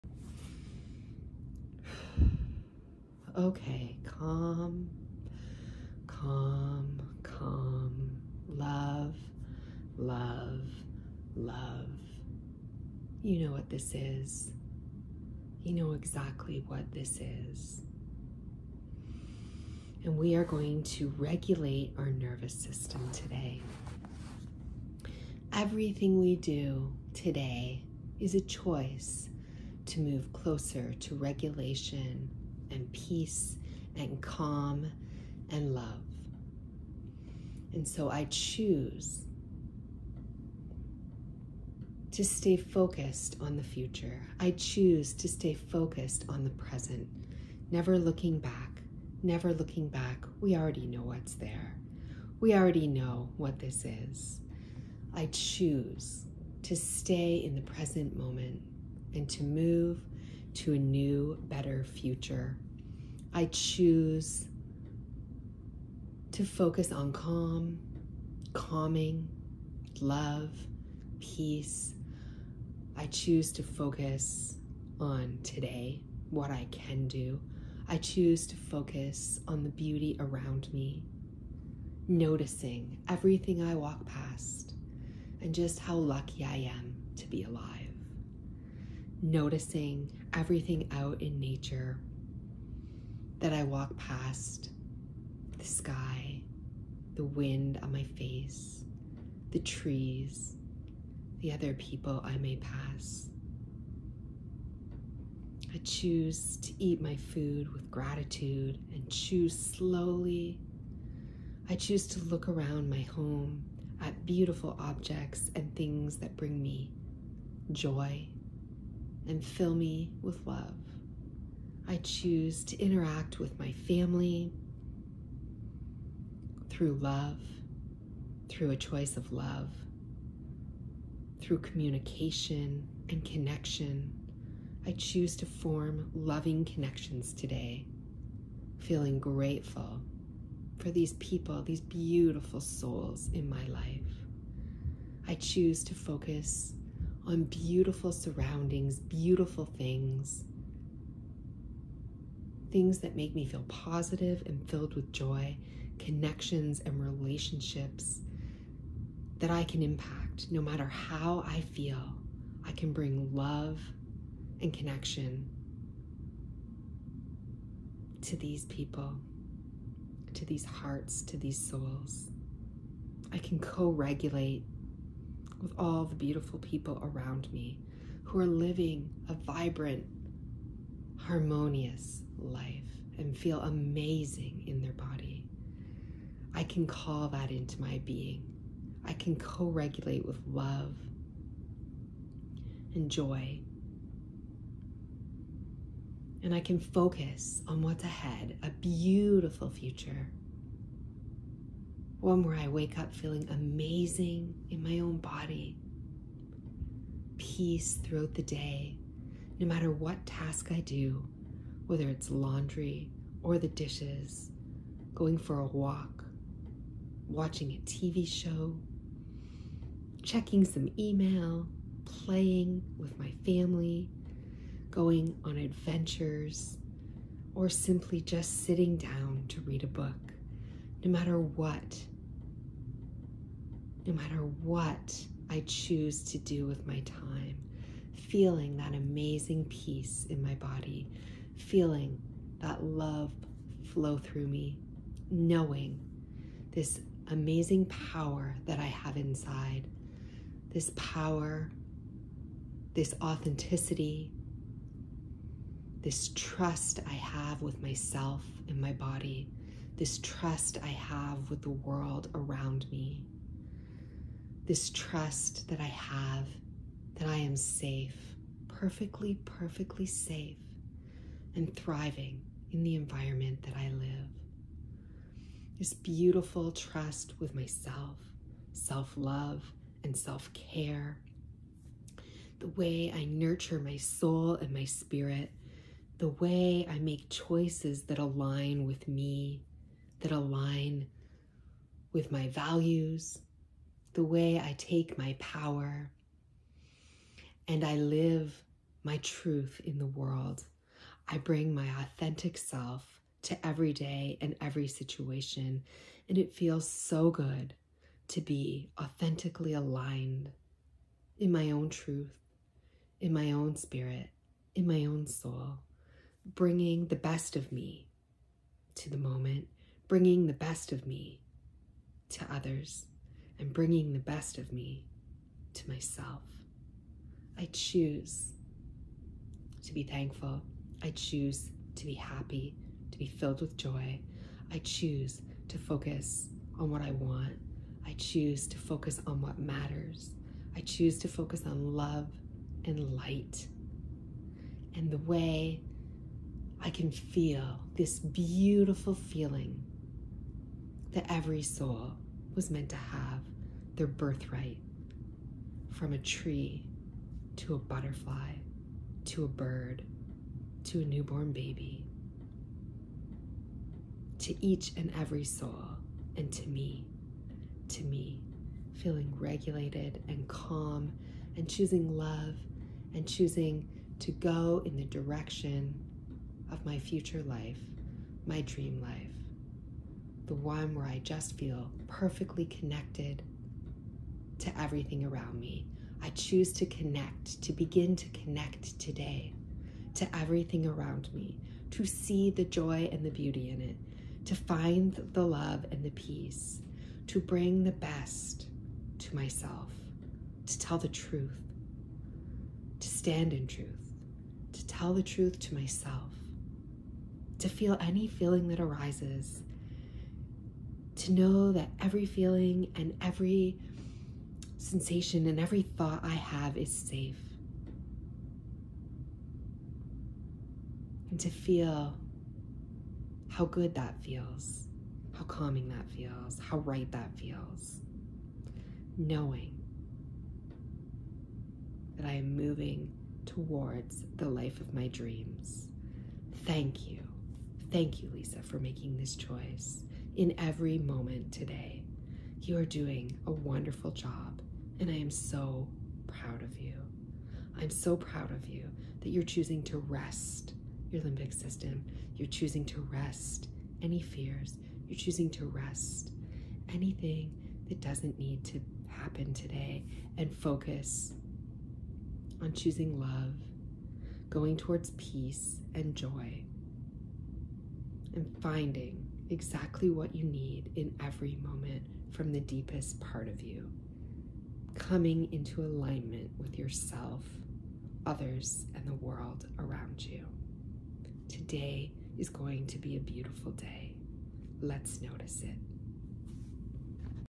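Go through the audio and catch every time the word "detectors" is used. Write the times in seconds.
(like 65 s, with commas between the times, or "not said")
not said.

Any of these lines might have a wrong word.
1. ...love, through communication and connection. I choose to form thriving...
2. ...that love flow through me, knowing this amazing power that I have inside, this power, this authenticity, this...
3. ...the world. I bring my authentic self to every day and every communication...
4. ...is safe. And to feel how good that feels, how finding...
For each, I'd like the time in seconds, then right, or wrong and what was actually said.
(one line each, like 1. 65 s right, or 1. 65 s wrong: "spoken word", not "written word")
1. 129 s wrong: "loving", not "thriving"
2. 242 s right
3. 299 s wrong: "situation", not "communication"
4. 416 s wrong: "calming", not "finding".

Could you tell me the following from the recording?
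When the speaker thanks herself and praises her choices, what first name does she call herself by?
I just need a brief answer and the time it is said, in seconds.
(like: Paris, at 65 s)
Lisa, at 438 s.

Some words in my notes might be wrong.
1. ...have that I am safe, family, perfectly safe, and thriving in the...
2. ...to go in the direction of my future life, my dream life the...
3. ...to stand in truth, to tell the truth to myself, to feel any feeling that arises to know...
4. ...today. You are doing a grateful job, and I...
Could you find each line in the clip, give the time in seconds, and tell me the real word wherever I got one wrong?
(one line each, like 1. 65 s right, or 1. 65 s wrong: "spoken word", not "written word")
1. 265 s wrong: "perfectly", not "family"
2. 374 s right
3. 402 s right
4. 441 s wrong: "wonderful", not "grateful".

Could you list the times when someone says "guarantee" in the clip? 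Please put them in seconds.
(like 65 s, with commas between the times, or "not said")
not said.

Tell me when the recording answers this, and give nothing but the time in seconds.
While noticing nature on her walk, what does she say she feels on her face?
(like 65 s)
97 s.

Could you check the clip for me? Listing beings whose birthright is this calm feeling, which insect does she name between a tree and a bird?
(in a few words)
Butterfly.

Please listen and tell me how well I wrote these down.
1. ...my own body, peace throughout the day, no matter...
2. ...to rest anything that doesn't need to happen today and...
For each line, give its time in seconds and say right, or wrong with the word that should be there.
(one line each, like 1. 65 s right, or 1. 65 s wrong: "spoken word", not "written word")
1. 204 s right
2. 455 s right.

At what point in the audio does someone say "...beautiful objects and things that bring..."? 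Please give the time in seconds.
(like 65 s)
114 s.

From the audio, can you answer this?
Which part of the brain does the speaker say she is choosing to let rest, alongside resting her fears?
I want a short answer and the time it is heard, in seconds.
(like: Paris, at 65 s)
Limbic system, at 451 s.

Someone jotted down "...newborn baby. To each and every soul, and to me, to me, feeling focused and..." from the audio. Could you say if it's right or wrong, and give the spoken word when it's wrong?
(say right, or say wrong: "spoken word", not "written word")
wrong: "regulated", not "focused".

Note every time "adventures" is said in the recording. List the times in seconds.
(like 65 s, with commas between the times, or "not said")
225 s.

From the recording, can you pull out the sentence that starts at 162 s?
I can bring love and connection to these people, to these hearts, to these souls.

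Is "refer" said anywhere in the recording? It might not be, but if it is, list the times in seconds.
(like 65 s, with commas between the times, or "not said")
not said.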